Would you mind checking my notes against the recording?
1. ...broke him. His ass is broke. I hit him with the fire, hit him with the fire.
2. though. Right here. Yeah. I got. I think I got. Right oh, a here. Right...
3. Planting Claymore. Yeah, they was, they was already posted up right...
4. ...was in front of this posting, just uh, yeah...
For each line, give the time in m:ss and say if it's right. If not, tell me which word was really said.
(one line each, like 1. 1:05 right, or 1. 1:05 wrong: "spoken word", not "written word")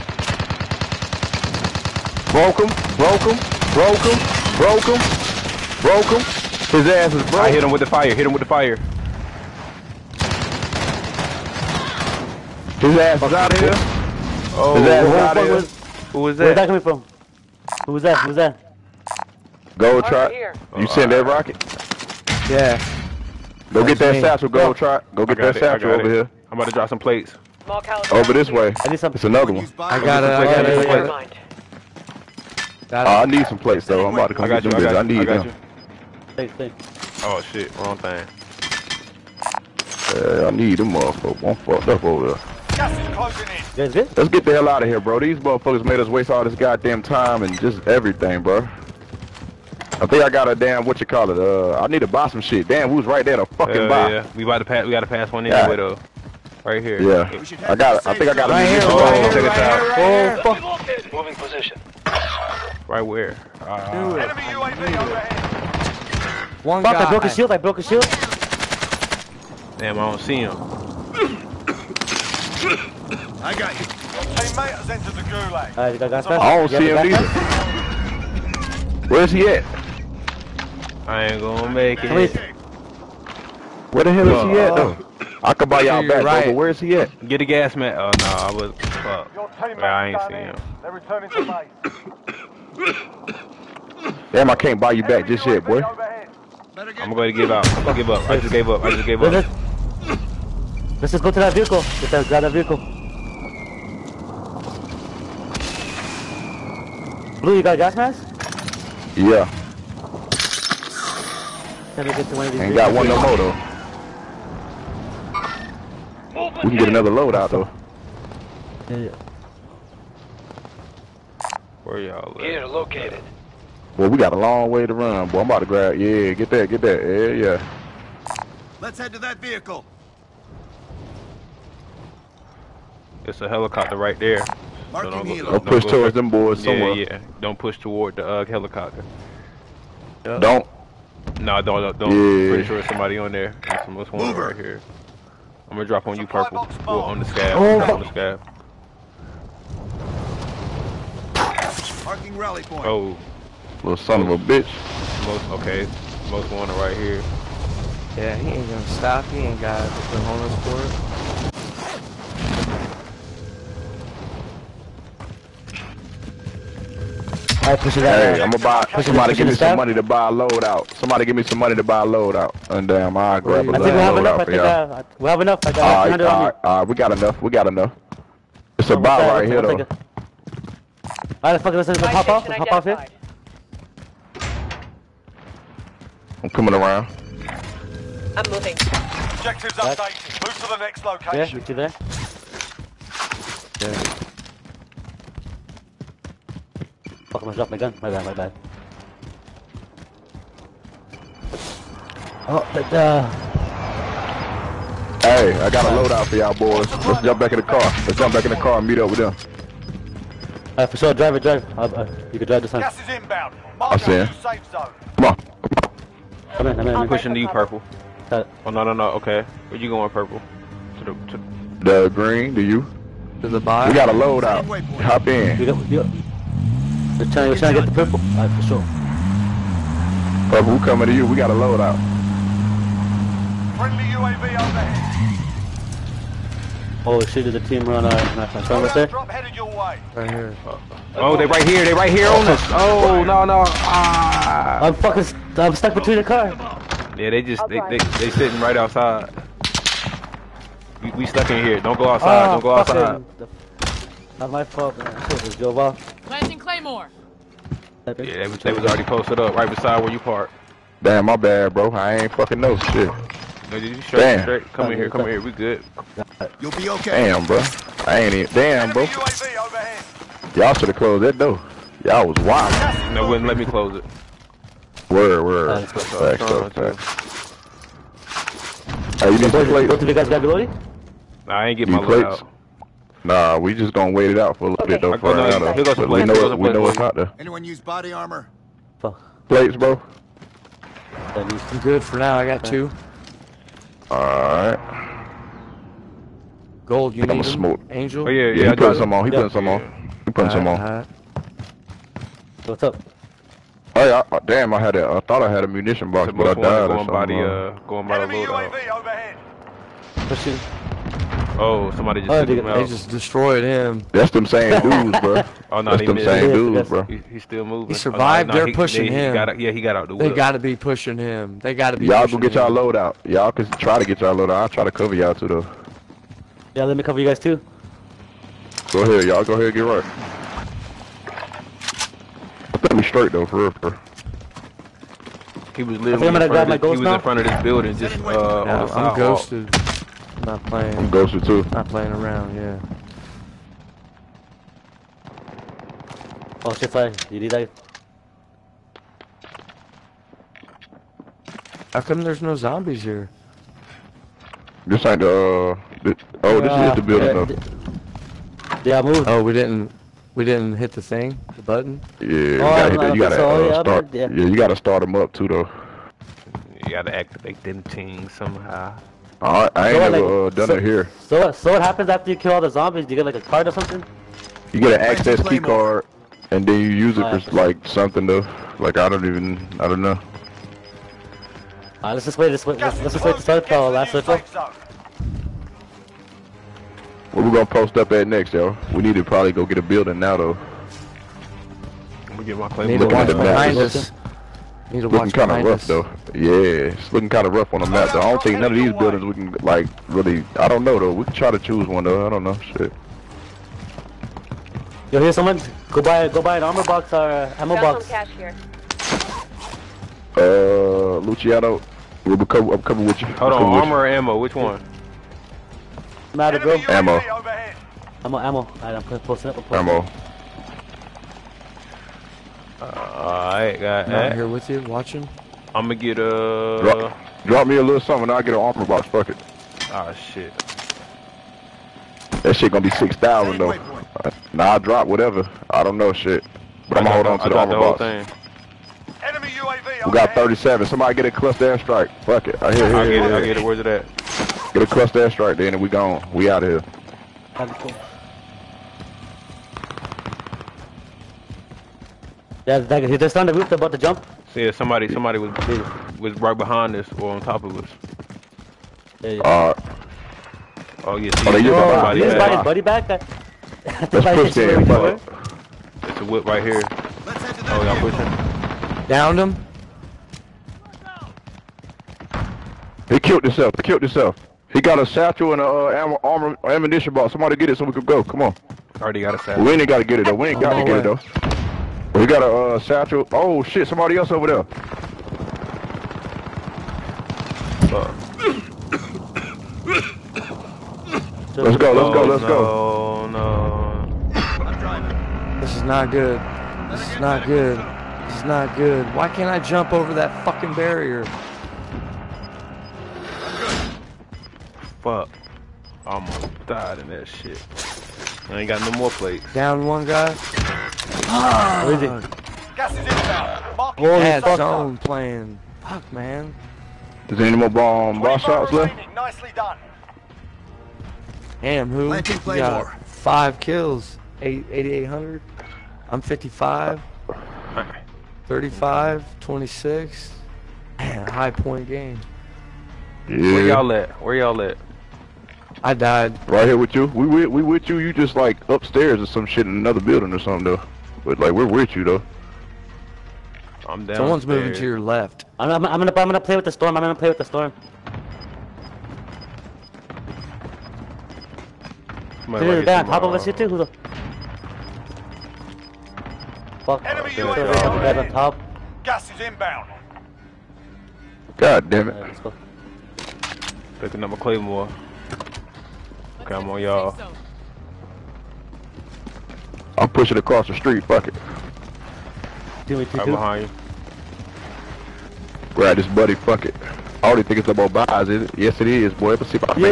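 1. 0:05 right
2. 0:55 right
3. 4:16 right
4. 5:36 wrong: "building", not "posting".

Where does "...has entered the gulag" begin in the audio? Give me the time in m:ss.
1:14.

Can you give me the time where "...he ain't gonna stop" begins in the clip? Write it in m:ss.
2:38.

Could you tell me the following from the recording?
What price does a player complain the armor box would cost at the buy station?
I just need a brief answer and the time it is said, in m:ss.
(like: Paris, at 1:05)
6,000, at 7:12.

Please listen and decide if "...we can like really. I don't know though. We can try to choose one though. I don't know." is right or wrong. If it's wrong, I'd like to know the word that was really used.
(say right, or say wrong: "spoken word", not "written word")
right.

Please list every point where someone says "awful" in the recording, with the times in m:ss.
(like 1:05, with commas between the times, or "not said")
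not said.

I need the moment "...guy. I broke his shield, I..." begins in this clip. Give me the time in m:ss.
1:06.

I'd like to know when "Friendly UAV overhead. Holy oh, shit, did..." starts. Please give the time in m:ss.
3:53.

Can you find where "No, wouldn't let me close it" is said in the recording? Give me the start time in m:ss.
4:33.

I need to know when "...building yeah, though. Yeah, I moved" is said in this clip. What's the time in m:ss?
5:57.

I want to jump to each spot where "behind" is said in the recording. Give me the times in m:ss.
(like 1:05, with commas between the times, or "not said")
6:33, 7:36, 9:33.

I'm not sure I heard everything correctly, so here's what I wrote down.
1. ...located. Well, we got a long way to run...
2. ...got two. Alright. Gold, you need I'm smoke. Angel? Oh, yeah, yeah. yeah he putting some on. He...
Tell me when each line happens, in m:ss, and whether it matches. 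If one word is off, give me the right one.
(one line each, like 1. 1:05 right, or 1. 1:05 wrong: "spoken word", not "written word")
1. 2:02 right
2. 4:52 right.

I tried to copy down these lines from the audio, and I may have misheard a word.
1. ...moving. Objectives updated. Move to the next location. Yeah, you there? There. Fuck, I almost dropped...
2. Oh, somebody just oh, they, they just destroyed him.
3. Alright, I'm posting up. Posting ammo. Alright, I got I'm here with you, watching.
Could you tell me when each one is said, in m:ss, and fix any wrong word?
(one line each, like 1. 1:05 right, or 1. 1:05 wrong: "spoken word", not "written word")
1. 3:08 right
2. 5:11 right
3. 6:58 right.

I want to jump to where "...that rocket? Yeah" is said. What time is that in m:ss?
0:21.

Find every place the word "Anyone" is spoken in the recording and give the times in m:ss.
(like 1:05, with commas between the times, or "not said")
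4:47.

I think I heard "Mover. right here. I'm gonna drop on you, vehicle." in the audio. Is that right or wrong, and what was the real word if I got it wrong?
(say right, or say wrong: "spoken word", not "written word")
wrong: "purple", not "vehicle".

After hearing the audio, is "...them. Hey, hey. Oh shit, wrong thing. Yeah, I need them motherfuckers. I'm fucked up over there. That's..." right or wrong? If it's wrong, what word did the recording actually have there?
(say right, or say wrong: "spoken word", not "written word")
right.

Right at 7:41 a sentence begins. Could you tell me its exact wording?
See, oh, they just got buddy back.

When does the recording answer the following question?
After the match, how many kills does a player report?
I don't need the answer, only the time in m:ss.
8:43.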